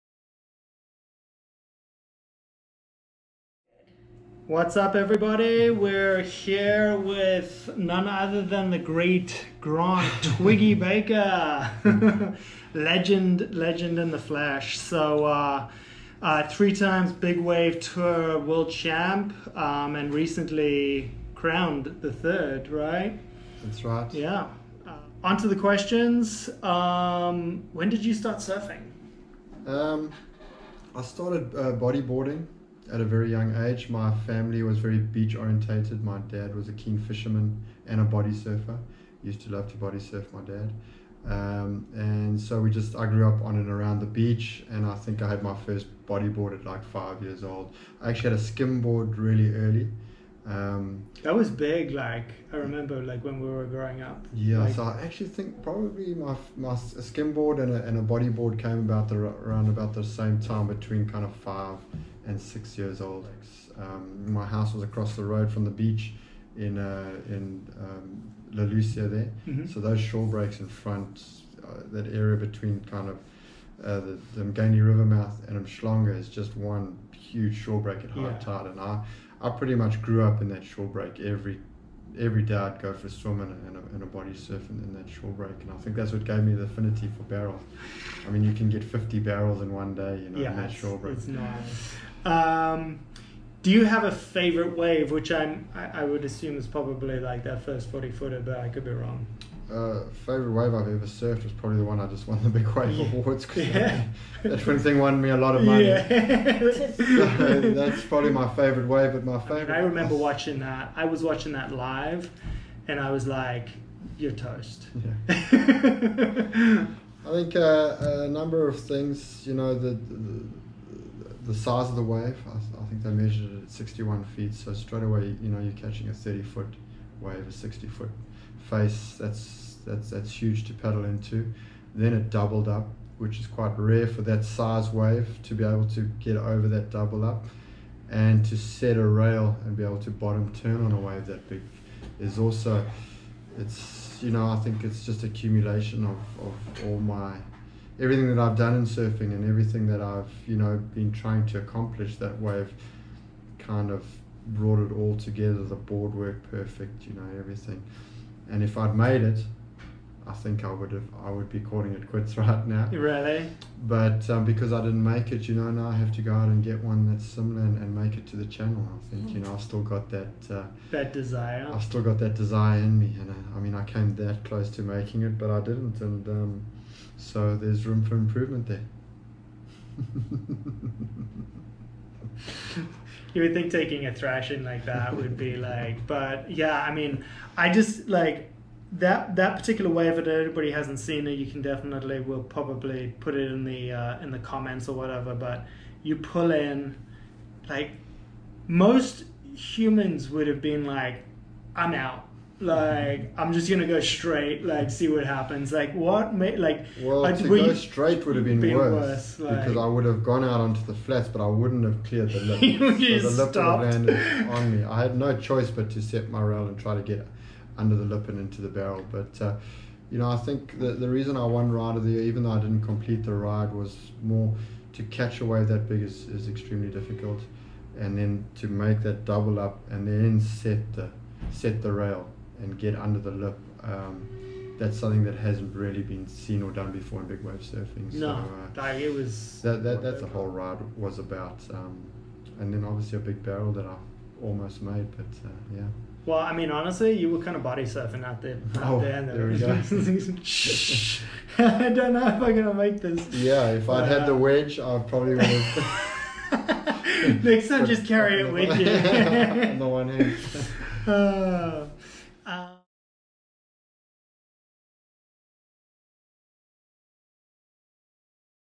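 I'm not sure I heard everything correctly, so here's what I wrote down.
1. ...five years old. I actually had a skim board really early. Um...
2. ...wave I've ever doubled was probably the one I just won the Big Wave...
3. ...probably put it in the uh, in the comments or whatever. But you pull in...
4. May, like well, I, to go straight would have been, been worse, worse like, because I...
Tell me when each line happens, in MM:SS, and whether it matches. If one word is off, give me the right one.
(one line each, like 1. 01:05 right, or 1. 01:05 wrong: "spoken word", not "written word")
1. 00:46 right
2. 01:40 wrong: "surfed", not "doubled"
3. 03:12 right
4. 03:26 right.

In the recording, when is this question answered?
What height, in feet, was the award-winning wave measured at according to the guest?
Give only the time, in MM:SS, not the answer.
02:03.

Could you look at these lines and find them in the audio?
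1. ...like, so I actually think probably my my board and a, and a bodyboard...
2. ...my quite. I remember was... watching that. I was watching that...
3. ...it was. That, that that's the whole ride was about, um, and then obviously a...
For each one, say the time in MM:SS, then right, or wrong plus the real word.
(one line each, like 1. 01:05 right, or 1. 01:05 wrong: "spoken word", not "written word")
1. 00:54 right
2. 01:49 wrong: "favorite", not "quite"
3. 03:58 right.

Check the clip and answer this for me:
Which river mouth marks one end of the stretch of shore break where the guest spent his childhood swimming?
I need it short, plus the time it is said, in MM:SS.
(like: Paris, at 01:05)
Umgeni River, at 01:14.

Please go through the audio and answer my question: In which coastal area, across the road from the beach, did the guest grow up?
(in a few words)
La Lucia.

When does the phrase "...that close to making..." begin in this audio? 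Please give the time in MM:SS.
02:54.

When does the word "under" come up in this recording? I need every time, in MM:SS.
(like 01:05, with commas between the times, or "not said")
03:37, 03:52.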